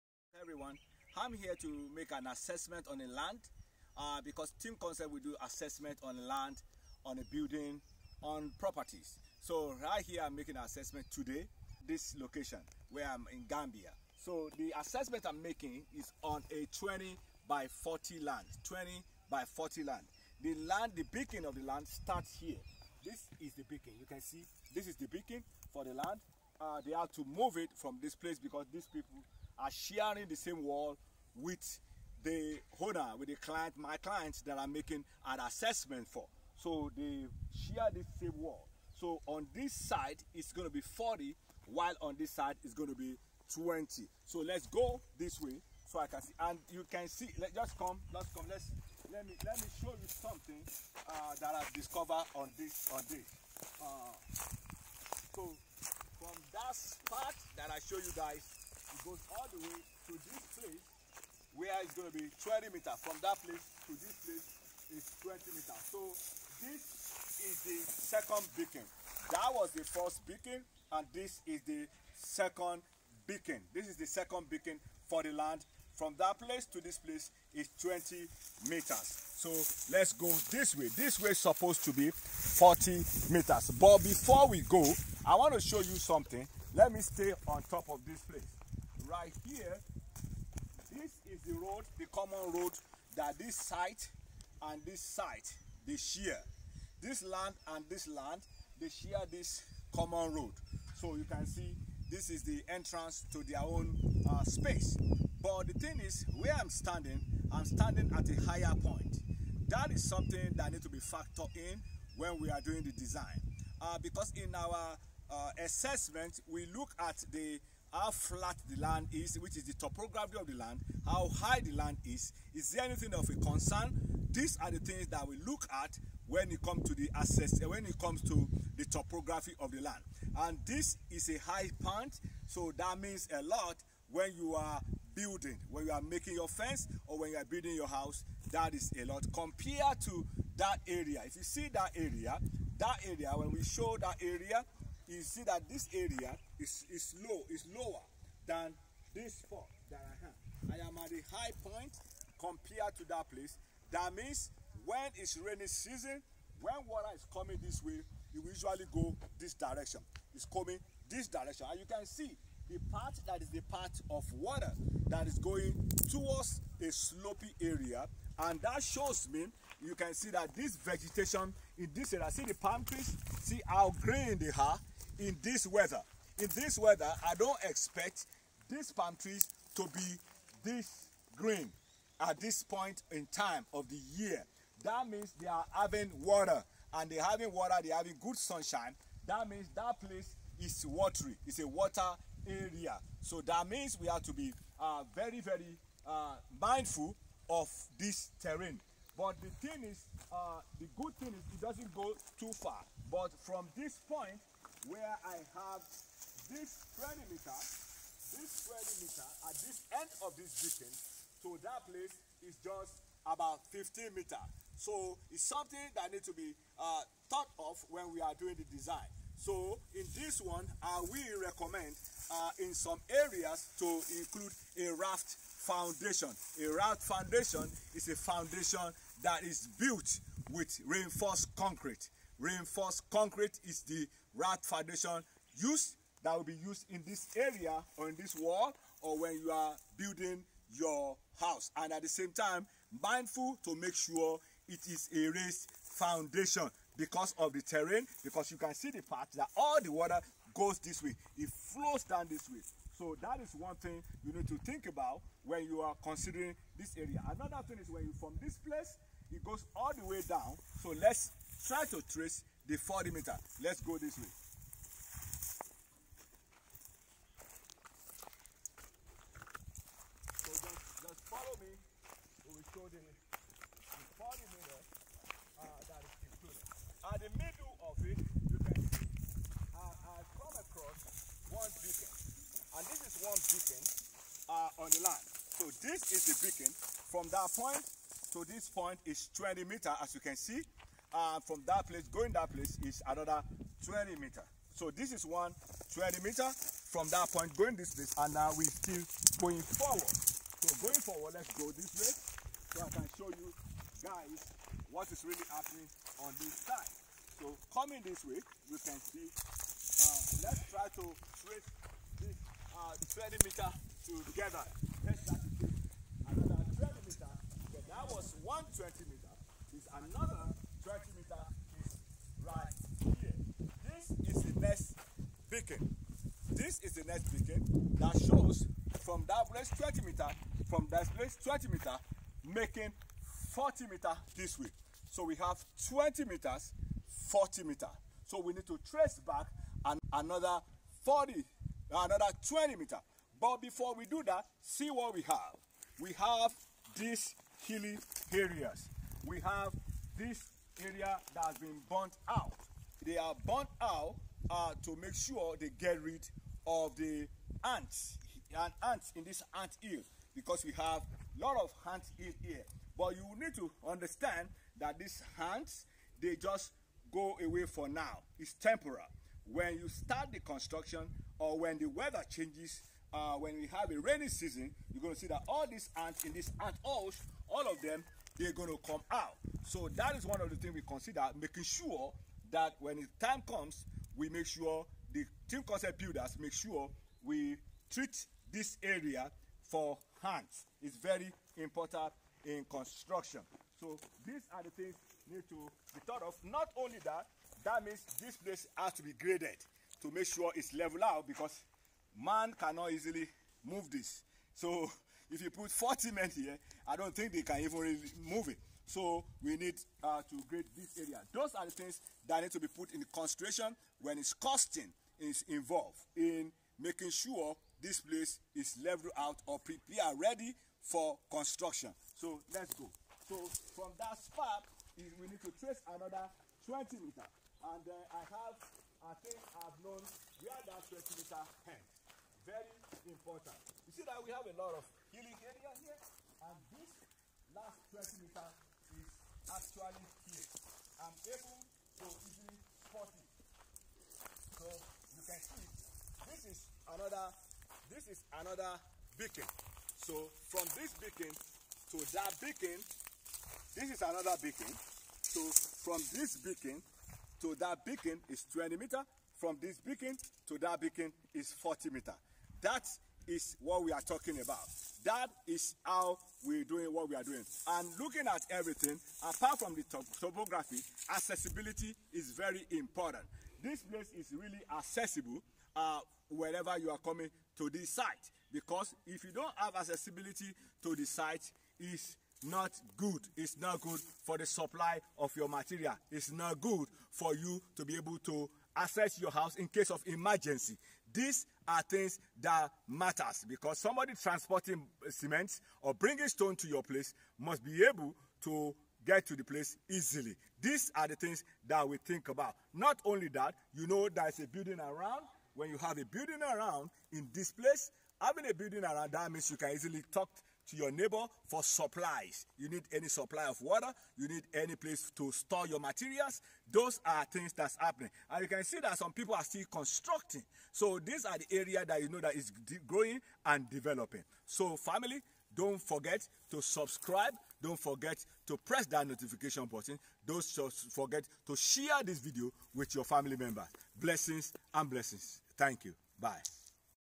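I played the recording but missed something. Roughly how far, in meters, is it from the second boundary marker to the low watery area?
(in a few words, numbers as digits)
15 meters.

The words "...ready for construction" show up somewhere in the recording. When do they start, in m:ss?
7:00.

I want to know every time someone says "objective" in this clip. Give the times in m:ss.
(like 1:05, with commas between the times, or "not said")
not said.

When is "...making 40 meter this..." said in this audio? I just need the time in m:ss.
5:32.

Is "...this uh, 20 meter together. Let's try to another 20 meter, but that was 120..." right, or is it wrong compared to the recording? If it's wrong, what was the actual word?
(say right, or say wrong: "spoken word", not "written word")
right.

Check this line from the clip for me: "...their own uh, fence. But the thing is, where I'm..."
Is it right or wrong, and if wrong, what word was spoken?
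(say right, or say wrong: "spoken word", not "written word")
wrong: "space", not "fence".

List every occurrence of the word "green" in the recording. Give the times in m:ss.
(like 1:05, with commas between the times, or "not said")
2:54, 3:01.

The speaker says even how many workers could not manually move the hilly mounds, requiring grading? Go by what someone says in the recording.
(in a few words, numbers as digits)
40.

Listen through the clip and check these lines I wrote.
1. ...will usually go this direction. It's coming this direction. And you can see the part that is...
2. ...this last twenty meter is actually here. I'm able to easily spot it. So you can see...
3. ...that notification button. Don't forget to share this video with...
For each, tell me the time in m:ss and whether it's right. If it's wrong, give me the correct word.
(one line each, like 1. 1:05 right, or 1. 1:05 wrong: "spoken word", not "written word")
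1. 2:38 right
2. 7:16 right
3. 8:48 right.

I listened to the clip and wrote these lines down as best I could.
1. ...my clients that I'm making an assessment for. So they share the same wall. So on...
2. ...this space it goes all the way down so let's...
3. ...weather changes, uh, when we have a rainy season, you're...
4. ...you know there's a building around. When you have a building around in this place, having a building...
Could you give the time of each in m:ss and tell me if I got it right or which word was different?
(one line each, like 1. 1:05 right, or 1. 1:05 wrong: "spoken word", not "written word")
1. 0:33 right
2. 4:18 wrong: "place", not "space"
3. 6:11 right
4. 8:23 right.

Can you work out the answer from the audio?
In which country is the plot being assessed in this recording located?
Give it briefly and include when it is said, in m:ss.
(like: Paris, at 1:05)
Gambia, at 0:13.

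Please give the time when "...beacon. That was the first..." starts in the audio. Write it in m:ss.
1:08.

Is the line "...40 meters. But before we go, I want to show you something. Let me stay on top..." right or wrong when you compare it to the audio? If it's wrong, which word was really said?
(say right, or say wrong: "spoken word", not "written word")
right.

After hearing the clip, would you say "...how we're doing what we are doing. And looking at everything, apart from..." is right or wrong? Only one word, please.
right.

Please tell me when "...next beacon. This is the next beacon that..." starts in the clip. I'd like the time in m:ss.
5:24.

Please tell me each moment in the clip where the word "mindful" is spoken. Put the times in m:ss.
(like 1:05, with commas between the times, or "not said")
3:16, 4:03.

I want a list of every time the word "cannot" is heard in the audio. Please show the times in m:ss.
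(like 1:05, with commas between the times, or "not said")
6:42.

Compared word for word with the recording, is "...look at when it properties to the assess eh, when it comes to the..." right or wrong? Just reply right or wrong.
wrong.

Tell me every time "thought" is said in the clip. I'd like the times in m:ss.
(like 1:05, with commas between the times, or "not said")
3:37, 6:36.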